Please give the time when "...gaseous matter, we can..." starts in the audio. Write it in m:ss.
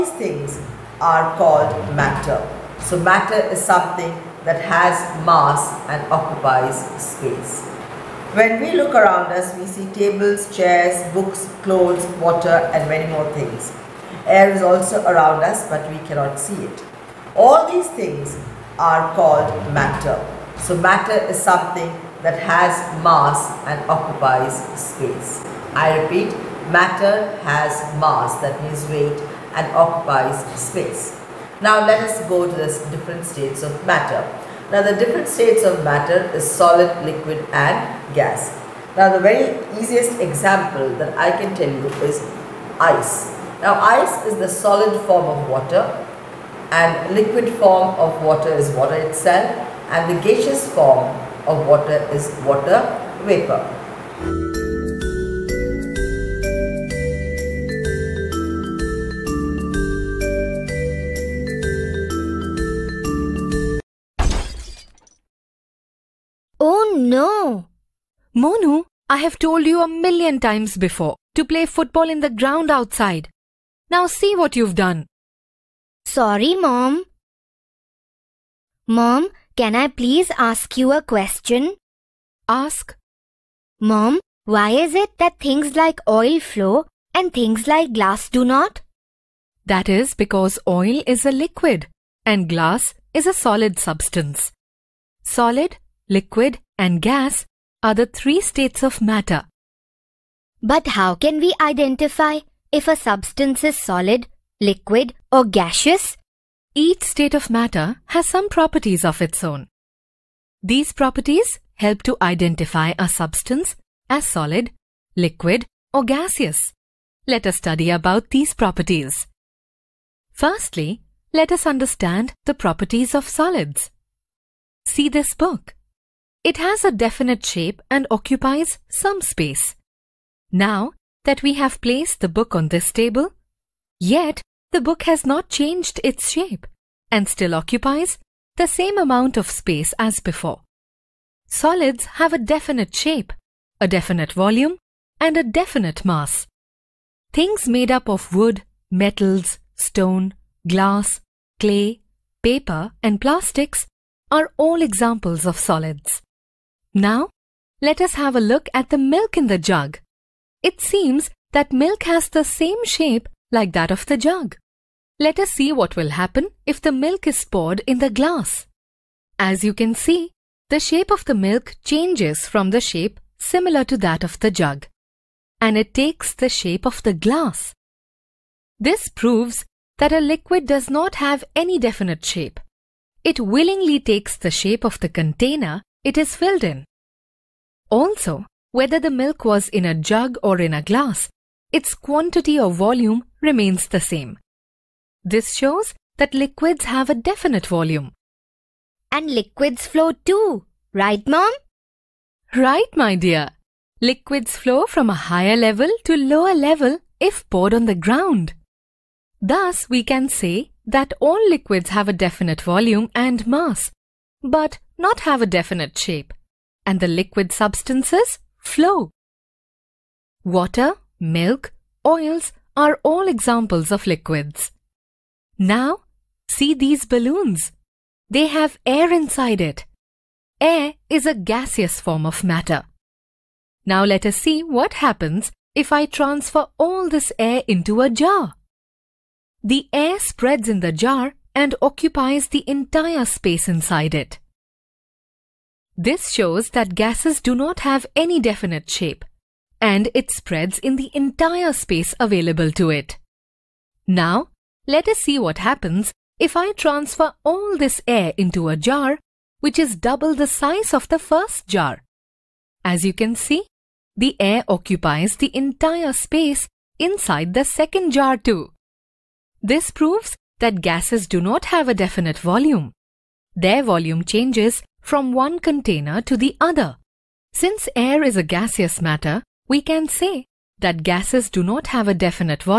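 4:38.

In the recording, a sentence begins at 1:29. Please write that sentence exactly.
That is because oil is a liquid and glass is a solid substance.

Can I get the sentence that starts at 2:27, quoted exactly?
Things made up of wood, metals, stone, glass, clay, paper, and plastics are all examples of solids.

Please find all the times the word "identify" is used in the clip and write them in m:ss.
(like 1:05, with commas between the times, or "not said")
1:41, 1:52.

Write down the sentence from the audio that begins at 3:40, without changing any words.
Water, milk, oils, are all examples of liquids.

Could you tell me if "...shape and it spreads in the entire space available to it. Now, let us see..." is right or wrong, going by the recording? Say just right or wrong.
right.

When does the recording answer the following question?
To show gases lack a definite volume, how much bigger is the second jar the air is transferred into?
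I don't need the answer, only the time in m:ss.
4:19.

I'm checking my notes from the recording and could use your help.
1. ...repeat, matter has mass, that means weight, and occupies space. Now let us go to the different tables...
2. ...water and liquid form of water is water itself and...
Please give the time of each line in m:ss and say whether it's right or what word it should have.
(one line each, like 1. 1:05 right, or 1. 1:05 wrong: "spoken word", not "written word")
1. 0:26 wrong: "states", not "tables"
2. 0:45 right.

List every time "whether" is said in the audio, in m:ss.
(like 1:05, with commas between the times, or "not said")
3:08.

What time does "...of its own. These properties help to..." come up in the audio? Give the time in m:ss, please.
1:49.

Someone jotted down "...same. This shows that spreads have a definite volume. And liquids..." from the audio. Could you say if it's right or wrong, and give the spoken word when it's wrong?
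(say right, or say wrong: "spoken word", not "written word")
wrong: "liquids", not "spreads".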